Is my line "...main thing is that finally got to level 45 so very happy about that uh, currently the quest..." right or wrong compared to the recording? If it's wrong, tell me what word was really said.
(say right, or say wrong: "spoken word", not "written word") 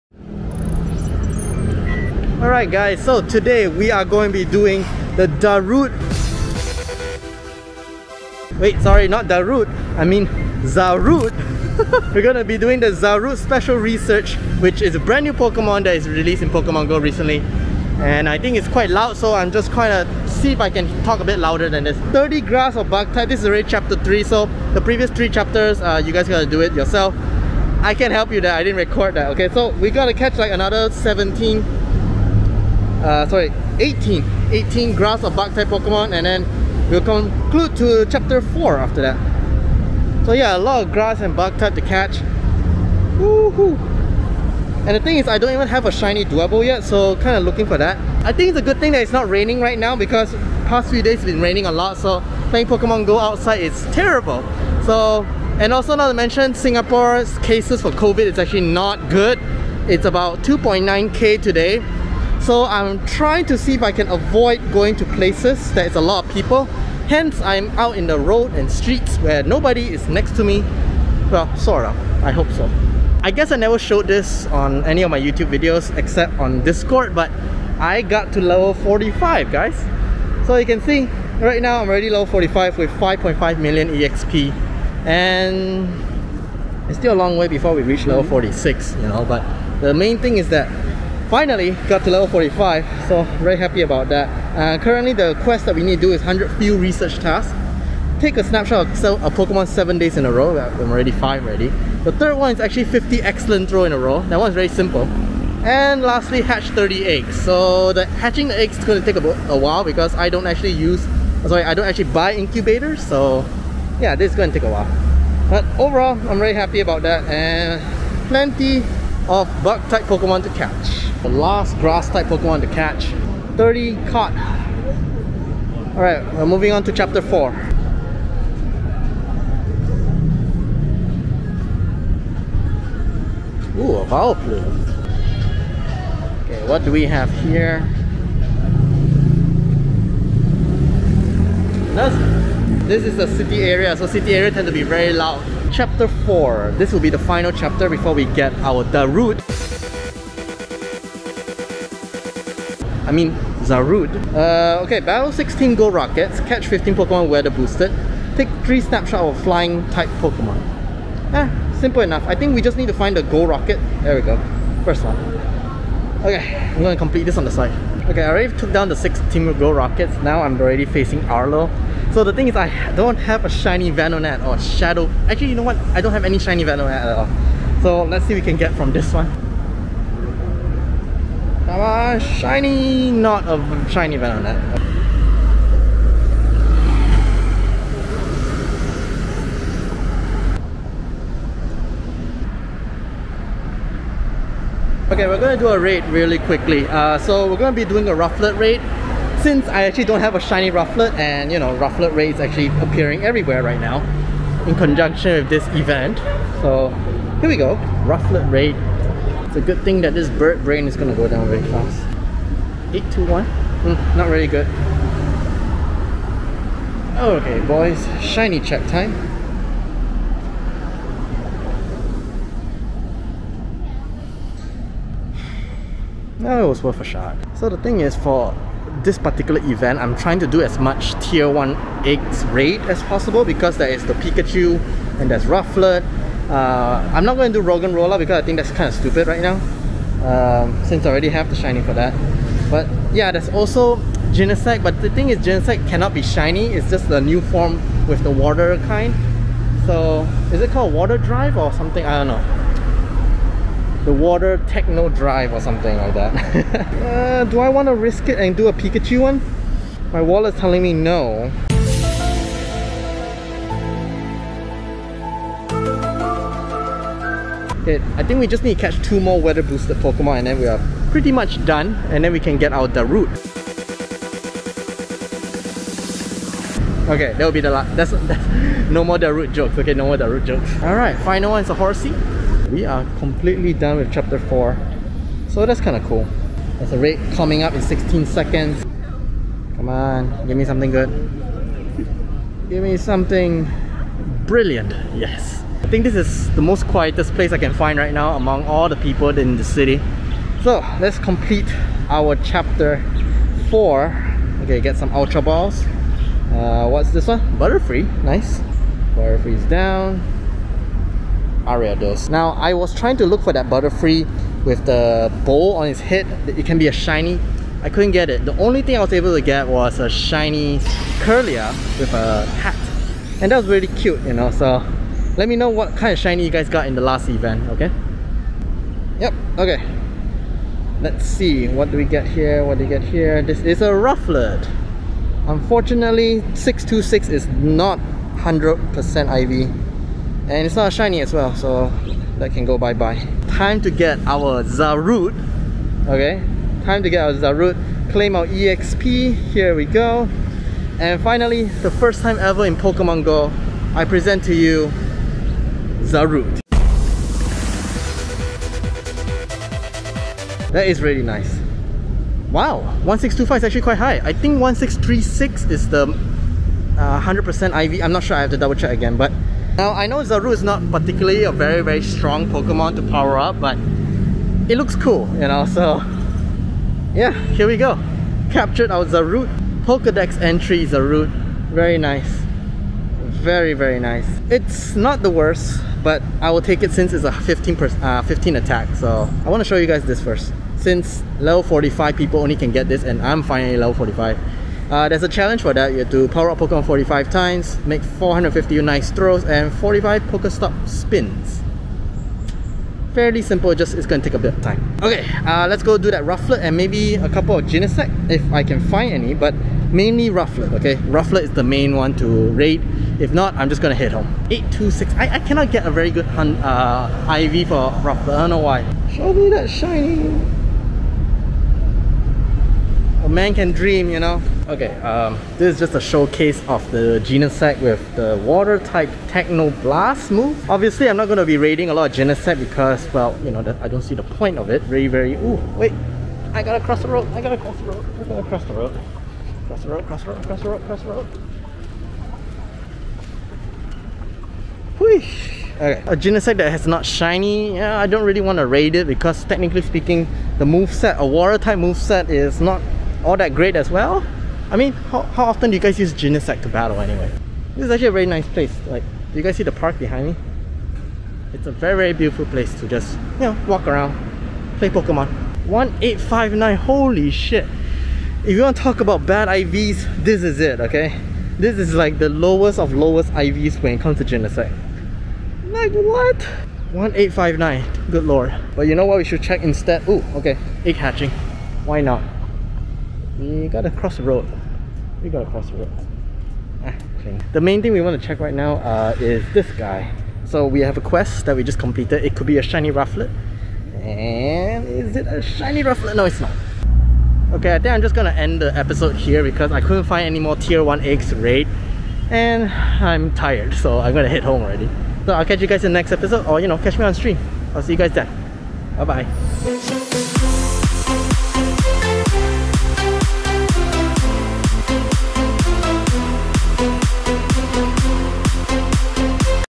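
right.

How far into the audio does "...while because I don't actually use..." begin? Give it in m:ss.
1:49.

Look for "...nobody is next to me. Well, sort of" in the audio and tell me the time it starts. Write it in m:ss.
1:09.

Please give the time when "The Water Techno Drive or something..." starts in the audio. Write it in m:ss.
4:14.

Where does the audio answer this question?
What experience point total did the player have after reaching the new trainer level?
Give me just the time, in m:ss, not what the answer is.
1:22.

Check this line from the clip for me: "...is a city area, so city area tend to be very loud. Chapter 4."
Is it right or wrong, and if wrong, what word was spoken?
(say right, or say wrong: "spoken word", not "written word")
right.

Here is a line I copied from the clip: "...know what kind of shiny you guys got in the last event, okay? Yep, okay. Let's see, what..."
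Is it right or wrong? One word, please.
right.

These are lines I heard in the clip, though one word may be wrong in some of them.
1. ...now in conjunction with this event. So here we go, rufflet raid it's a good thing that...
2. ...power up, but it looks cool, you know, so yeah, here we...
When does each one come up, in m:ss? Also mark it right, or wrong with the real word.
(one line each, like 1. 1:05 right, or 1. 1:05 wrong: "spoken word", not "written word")
1. 3:23 right
2. 6:13 right.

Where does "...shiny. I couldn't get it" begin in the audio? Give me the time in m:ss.
5:16.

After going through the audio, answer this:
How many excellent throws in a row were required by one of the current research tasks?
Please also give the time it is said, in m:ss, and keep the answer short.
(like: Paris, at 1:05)
50, at 1:42.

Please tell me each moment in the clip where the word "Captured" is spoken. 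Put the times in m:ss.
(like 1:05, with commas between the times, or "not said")
6:18.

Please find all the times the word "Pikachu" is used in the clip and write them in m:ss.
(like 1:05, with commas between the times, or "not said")
3:54, 4:18.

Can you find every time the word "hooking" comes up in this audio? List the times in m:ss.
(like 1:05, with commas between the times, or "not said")
not said.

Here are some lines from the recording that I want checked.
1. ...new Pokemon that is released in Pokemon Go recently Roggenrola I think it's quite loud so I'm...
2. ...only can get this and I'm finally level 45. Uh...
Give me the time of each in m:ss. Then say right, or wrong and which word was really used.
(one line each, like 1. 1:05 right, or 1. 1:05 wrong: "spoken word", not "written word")
1. 0:15 wrong: "And", not "Roggenrola"
2. 6:32 right.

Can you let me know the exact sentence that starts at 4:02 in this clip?
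But yeah, there's also Genesect, but the thing is Genesect cannot be shiny, it's just the new form with the water kind.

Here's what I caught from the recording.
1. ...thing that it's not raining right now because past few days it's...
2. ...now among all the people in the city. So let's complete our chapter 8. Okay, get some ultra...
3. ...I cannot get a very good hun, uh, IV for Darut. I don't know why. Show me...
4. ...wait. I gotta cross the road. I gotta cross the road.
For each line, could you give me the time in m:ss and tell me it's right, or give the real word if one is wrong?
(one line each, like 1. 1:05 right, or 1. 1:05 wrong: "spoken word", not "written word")
1. 0:48 right
2. 4:58 wrong: "4", not "8"
3. 6:55 wrong: "Rufflet", not "Darut"
4. 7:15 right.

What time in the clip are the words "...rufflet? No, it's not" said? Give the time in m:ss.
8:15.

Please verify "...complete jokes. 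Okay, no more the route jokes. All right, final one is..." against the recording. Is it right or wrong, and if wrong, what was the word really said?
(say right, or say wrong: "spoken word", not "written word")
wrong: "route", not "complete".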